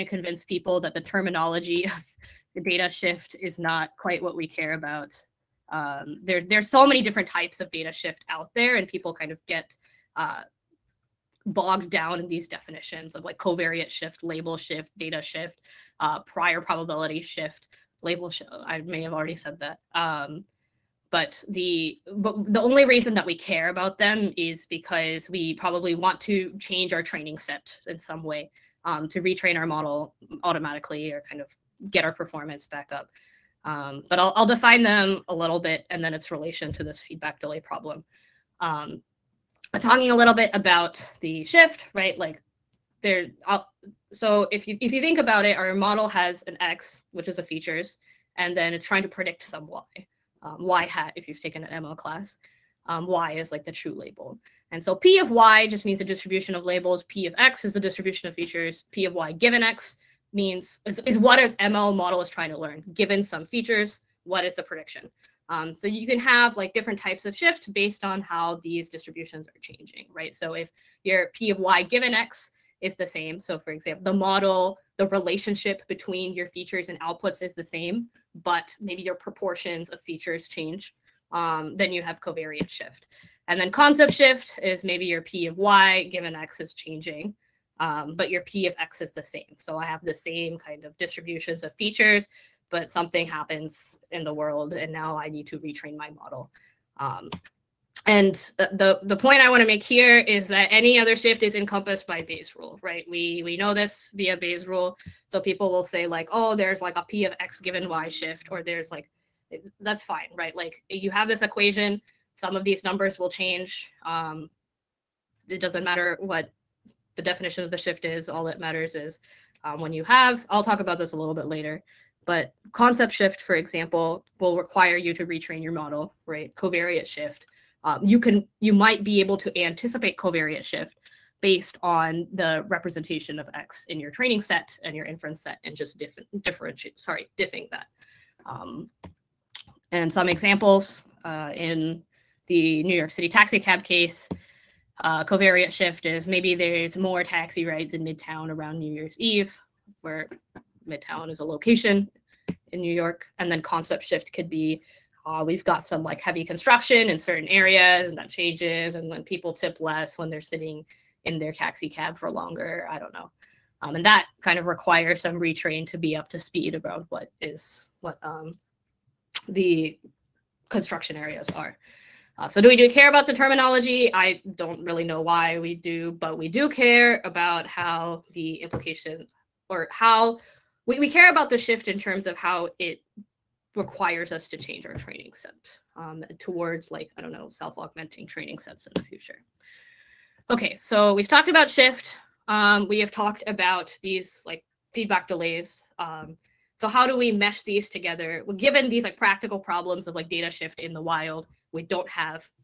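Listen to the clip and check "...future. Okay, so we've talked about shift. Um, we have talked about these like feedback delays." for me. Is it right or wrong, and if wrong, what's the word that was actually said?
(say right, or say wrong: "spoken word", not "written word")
right.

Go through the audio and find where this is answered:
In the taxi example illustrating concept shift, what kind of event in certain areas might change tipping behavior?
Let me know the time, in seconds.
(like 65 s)
156 s.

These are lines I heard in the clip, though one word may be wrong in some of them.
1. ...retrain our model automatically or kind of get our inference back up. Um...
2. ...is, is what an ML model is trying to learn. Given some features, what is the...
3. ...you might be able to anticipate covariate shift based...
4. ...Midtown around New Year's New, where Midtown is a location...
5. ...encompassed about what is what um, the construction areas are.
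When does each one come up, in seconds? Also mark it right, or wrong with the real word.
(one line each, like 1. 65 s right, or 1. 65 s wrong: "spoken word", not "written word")
1. 29 s wrong: "performance", not "inference"
2. 60 s right
3. 128 s right
4. 148 s wrong: "Eve", not "New"
5. 166 s wrong: "speed", not "encompassed".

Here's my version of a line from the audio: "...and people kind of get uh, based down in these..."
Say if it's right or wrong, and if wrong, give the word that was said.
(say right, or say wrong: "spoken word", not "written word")
wrong: "bogged", not "based".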